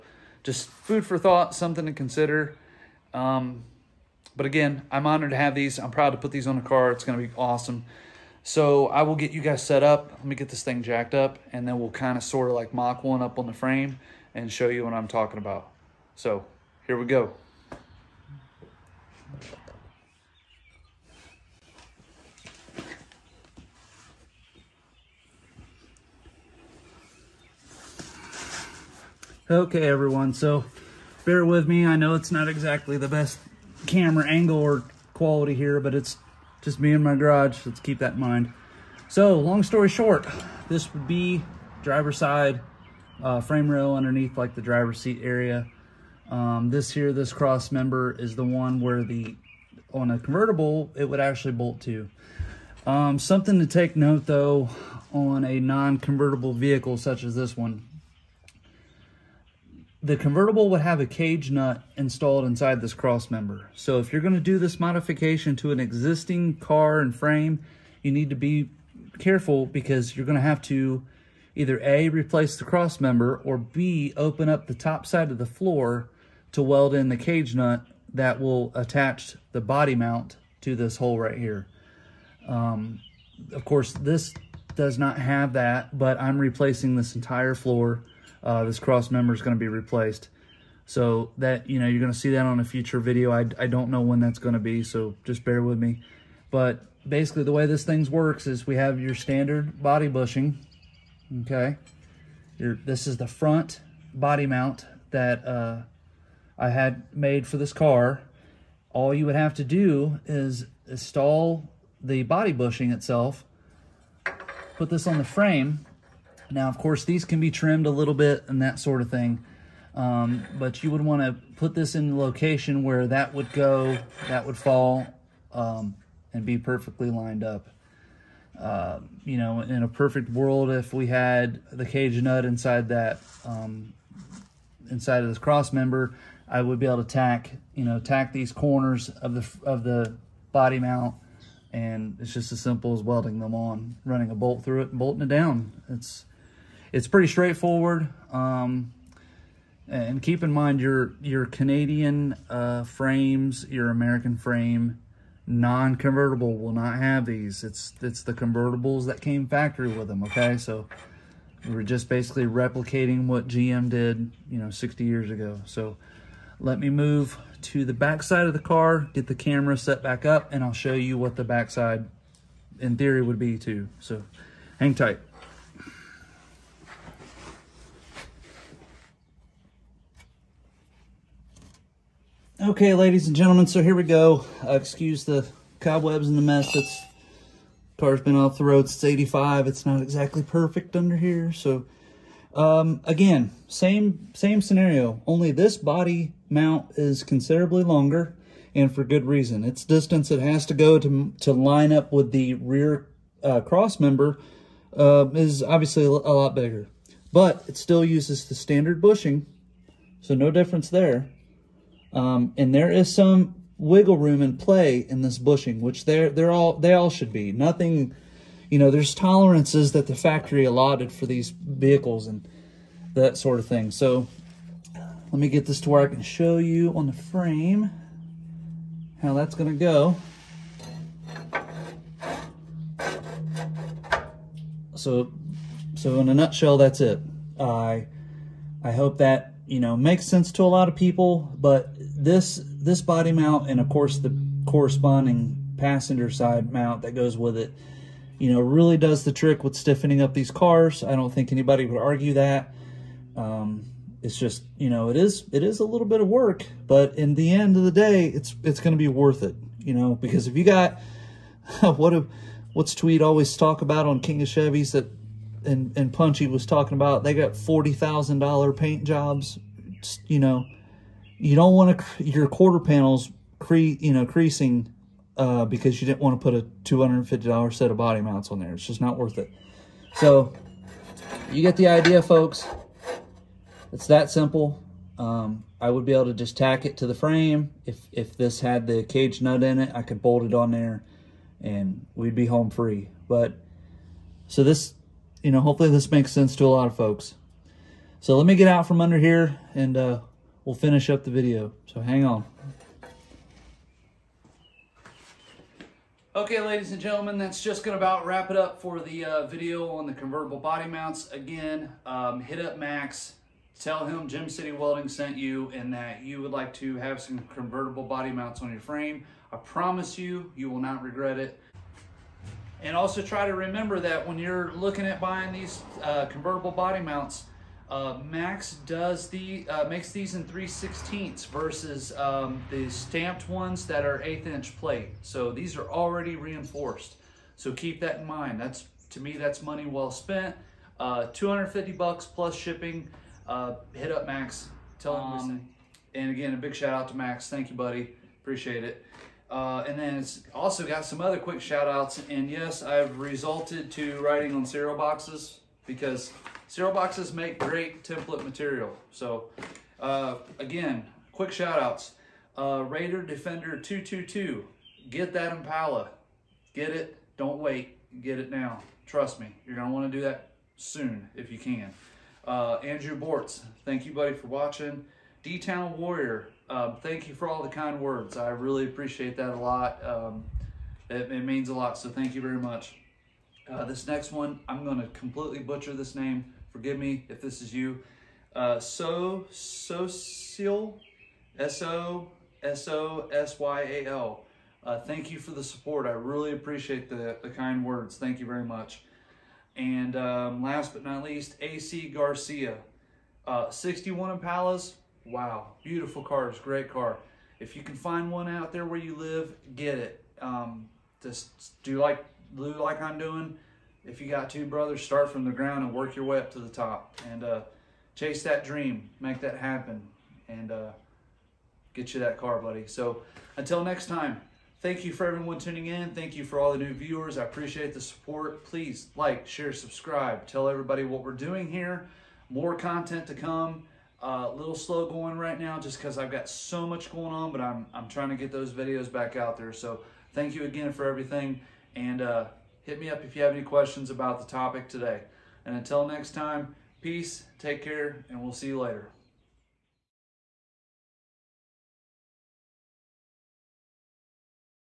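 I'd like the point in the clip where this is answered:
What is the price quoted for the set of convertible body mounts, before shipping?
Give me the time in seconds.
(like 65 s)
341 s.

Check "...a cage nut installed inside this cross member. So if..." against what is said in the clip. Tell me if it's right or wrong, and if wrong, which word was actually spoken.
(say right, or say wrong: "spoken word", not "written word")
right.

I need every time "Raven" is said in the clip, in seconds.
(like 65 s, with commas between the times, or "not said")
not said.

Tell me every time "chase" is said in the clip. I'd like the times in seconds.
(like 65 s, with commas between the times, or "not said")
418 s.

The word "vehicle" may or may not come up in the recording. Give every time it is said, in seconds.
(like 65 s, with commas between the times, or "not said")
56 s, 221 s.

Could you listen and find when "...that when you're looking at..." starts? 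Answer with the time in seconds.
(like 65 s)
323 s.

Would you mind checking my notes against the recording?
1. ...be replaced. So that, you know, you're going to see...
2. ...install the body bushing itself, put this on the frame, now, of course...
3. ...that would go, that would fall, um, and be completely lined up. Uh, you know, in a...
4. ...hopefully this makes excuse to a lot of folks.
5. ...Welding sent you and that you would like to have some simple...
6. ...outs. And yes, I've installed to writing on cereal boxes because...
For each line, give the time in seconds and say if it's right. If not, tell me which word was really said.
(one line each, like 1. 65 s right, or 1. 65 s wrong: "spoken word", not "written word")
1. 89 s right
2. 110 s right
3. 123 s wrong: "perfectly", not "completely"
4. 295 s wrong: "sense", not "excuse"
5. 314 s wrong: "convertible", not "simple"
6. 351 s wrong: "resulted", not "installed".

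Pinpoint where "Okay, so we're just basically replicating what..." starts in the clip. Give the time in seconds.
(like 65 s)
160 s.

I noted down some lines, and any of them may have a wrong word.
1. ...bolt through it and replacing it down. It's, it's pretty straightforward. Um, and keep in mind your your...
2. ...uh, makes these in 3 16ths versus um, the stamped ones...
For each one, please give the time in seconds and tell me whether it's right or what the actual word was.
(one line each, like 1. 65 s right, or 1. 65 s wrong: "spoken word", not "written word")
1. 144 s wrong: "bolting", not "replacing"
2. 329 s right.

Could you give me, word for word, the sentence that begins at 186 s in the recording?
It's car's been off the road since 85.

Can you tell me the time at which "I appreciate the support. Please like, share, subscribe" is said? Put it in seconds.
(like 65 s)
427 s.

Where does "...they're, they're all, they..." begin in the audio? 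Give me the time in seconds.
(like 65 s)
216 s.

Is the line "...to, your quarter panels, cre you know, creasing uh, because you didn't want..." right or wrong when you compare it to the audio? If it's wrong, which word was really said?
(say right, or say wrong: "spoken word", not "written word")
right.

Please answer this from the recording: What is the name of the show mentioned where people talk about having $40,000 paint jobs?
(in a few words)
King of Chevys.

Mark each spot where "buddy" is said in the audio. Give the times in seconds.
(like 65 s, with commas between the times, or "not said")
347 s, 374 s, 422 s.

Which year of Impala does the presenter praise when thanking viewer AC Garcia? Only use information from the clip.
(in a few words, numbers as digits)
1961.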